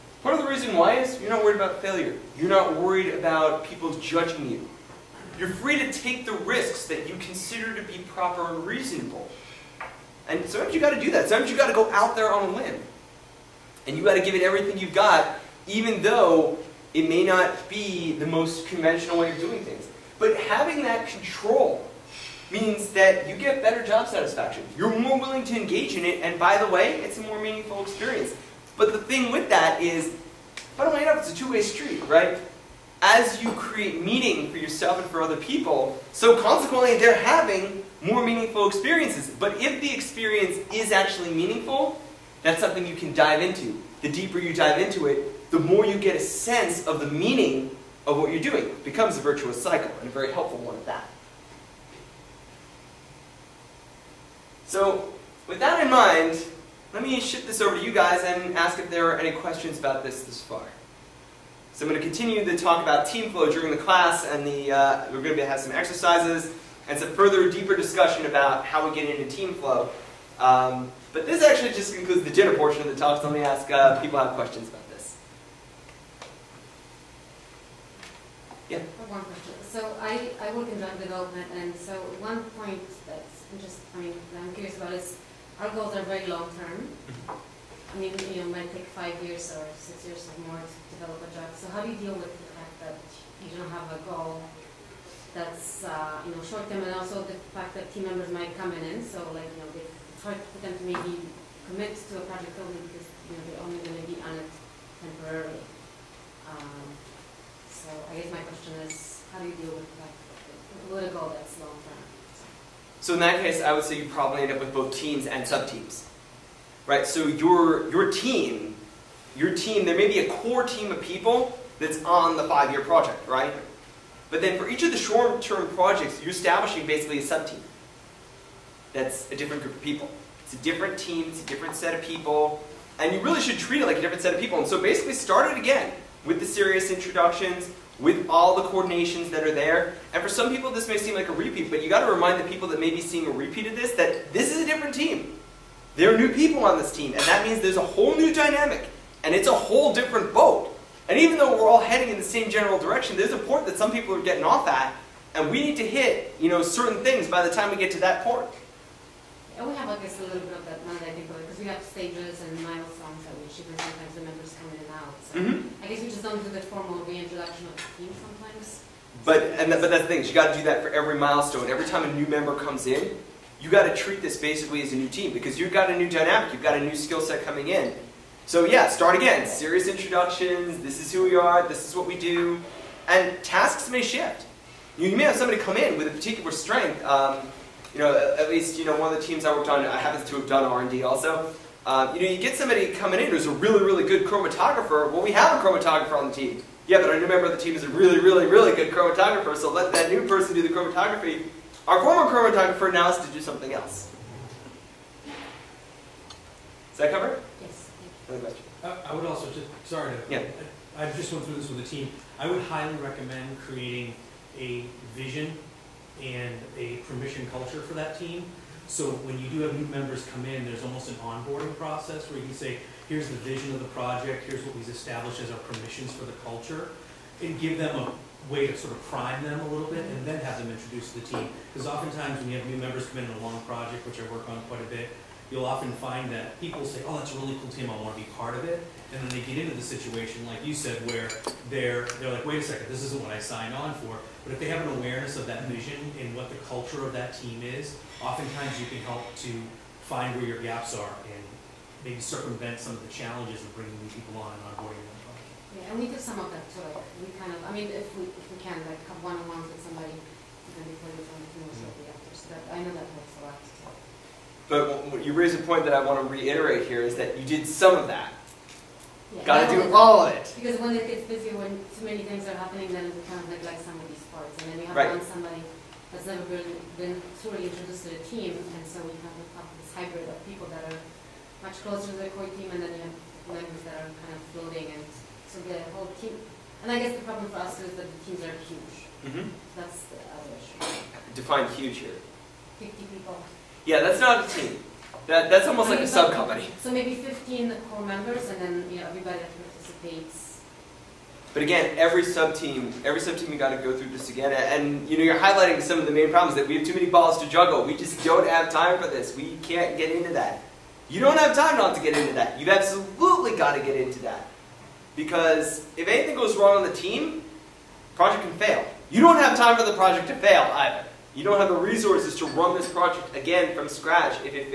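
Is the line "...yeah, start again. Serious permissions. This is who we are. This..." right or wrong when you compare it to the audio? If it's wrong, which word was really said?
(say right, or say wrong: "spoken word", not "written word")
wrong: "introductions", not "permissions".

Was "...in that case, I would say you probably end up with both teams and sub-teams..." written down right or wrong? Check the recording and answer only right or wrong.
right.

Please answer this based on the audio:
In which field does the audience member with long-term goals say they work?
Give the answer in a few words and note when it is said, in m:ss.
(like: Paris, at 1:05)
drug development, at 1:20.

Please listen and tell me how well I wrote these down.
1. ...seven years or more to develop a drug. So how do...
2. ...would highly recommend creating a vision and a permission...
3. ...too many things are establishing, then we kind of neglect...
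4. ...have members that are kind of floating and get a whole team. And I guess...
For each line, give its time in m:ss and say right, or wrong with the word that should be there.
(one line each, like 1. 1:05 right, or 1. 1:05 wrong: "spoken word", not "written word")
1. 1:29 wrong: "six", not "seven"
2. 3:32 right
3. 4:31 wrong: "happening", not "establishing"
4. 4:43 right.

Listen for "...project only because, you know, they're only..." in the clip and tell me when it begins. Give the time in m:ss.
1:42.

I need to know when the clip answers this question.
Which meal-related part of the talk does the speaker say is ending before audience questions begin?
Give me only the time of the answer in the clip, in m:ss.
1:12.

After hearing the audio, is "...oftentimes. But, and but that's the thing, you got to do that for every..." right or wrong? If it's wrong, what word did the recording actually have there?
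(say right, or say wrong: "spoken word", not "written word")
wrong: "sometimes", not "oftentimes".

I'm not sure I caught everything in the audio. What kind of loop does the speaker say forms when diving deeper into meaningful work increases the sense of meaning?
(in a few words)
virtuous cycle.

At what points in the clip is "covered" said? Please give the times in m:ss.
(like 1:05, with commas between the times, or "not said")
3:27.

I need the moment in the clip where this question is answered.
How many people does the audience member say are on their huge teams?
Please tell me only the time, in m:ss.
4:52.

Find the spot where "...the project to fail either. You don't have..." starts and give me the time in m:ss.
5:19.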